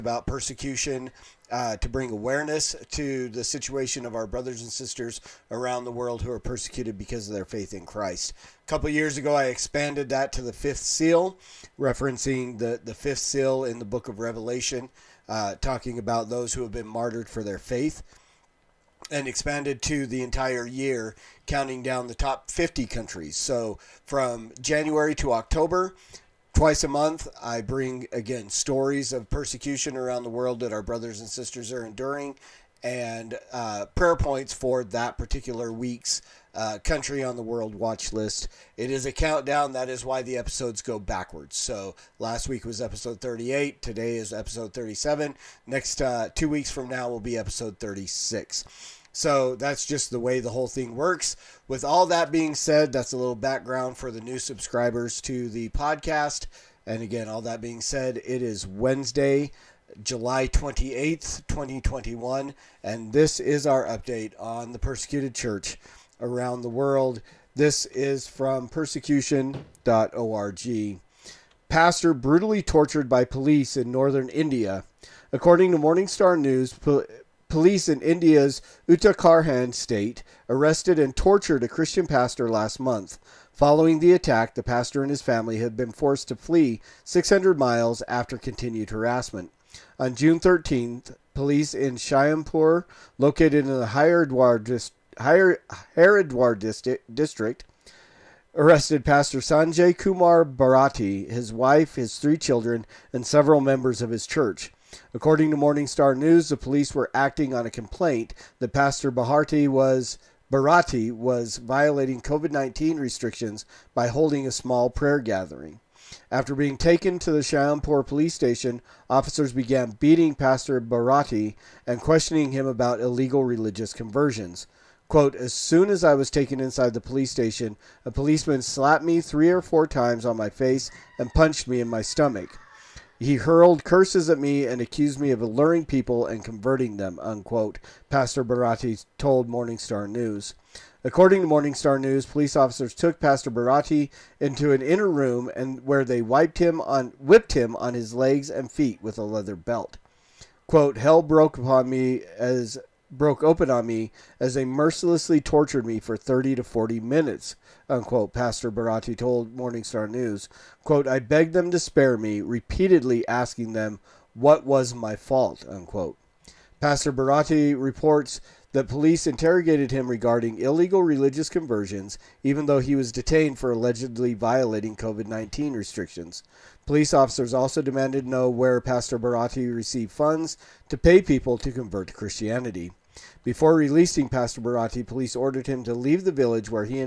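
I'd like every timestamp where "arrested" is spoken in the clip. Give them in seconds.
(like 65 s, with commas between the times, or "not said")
80 s, 98 s.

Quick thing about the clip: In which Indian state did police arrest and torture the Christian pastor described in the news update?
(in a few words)
Uttarakhand.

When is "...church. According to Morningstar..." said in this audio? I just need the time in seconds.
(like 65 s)
104 s.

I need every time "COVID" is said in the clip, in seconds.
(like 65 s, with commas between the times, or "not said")
112 s, 174 s.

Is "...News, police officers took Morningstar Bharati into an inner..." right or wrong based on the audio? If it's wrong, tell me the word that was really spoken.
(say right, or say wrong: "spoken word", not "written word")
wrong: "Pastor", not "Morningstar".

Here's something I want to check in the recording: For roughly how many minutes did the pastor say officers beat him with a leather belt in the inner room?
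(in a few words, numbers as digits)
30 to 40 minutes.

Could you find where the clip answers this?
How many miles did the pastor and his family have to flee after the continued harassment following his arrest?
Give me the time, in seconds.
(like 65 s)
87 s.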